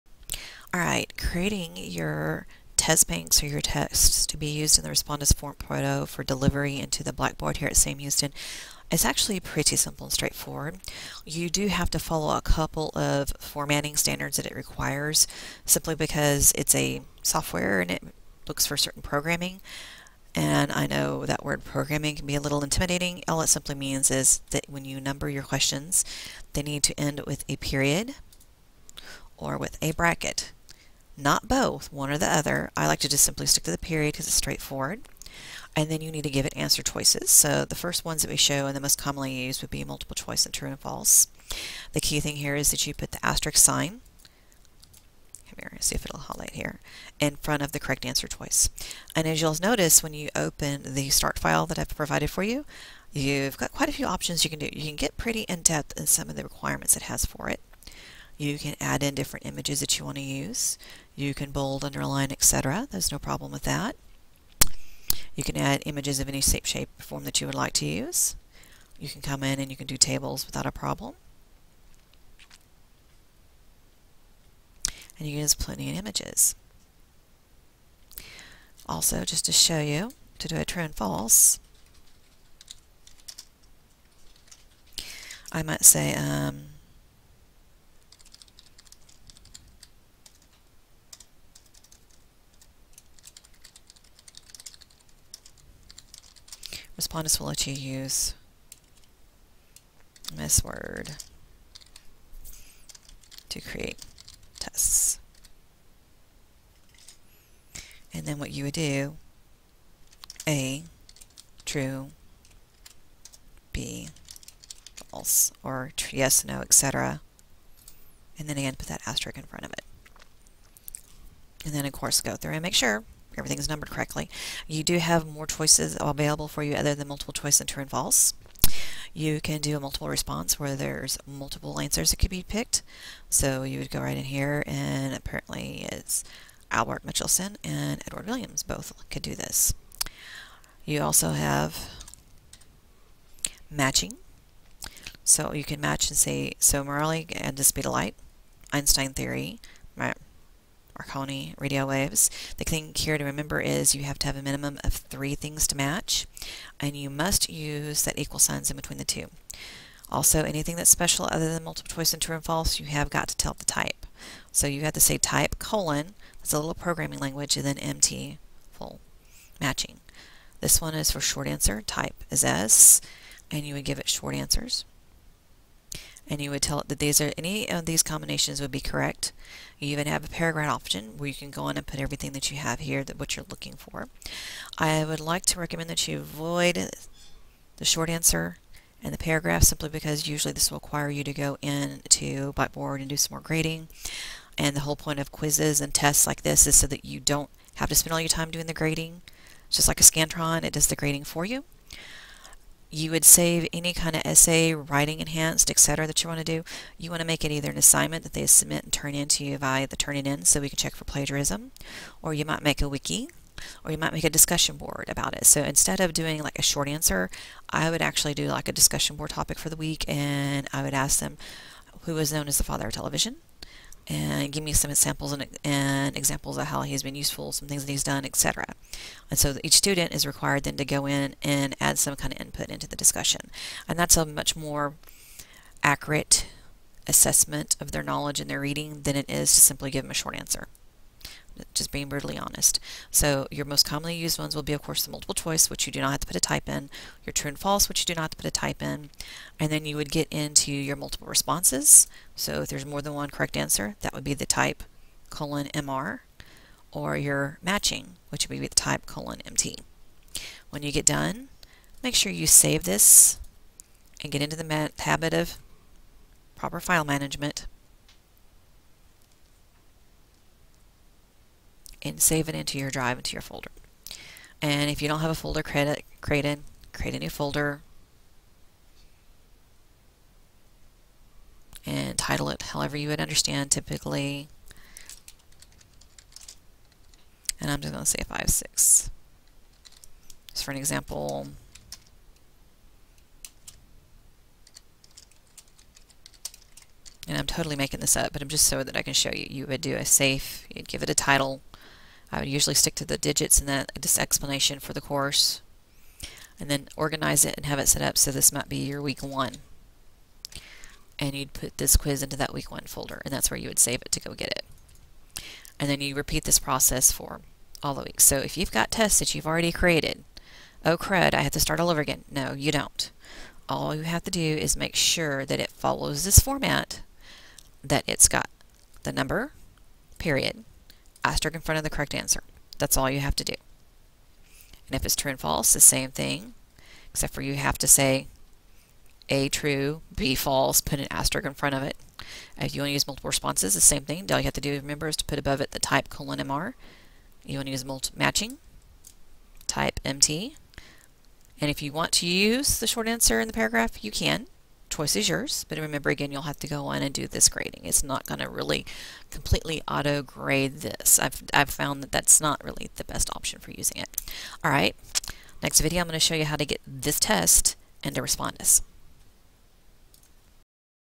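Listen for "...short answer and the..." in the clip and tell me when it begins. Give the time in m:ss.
3:07.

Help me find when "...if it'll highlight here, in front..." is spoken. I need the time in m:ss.
0:45.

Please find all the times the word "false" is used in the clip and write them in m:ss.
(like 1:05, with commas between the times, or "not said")
0:40, 1:20, 1:55, 2:07, 2:42, 4:07, 5:35, 5:40.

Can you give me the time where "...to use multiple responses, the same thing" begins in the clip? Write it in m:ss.
5:42.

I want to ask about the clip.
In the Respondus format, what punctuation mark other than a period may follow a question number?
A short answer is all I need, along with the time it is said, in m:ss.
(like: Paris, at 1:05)
bracket, at 0:29.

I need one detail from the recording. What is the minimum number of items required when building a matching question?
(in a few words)
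3.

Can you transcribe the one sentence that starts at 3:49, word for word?
And so each student is required then to go in and add some kind of input into the discussion.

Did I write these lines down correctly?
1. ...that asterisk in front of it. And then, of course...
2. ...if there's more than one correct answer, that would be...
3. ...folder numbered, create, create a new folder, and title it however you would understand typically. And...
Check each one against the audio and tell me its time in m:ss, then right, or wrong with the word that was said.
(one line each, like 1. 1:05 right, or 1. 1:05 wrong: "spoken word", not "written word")
1. 1:58 right
2. 4:12 right
3. 4:35 wrong: "created", not "numbered".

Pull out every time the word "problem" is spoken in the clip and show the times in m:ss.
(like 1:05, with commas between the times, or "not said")
1:03, 1:10.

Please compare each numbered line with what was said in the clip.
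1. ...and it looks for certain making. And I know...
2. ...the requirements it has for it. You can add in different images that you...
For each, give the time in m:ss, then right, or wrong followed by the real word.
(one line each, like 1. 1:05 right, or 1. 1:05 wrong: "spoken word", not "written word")
1. 0:17 wrong: "programming", not "making"
2. 0:56 right.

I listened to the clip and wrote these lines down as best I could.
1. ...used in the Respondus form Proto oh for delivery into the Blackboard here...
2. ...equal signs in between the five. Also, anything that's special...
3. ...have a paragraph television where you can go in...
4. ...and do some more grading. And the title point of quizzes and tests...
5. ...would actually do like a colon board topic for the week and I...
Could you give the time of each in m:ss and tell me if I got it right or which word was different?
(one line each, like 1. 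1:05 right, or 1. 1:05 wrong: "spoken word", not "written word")
1. 0:04 right
2. 2:38 wrong: "two", not "five"
3. 3:00 wrong: "option", not "television"
4. 3:13 wrong: "whole", not "title"
5. 3:37 wrong: "discussion", not "colon".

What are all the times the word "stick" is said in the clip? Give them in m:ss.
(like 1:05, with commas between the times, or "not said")
0:33, 5:02.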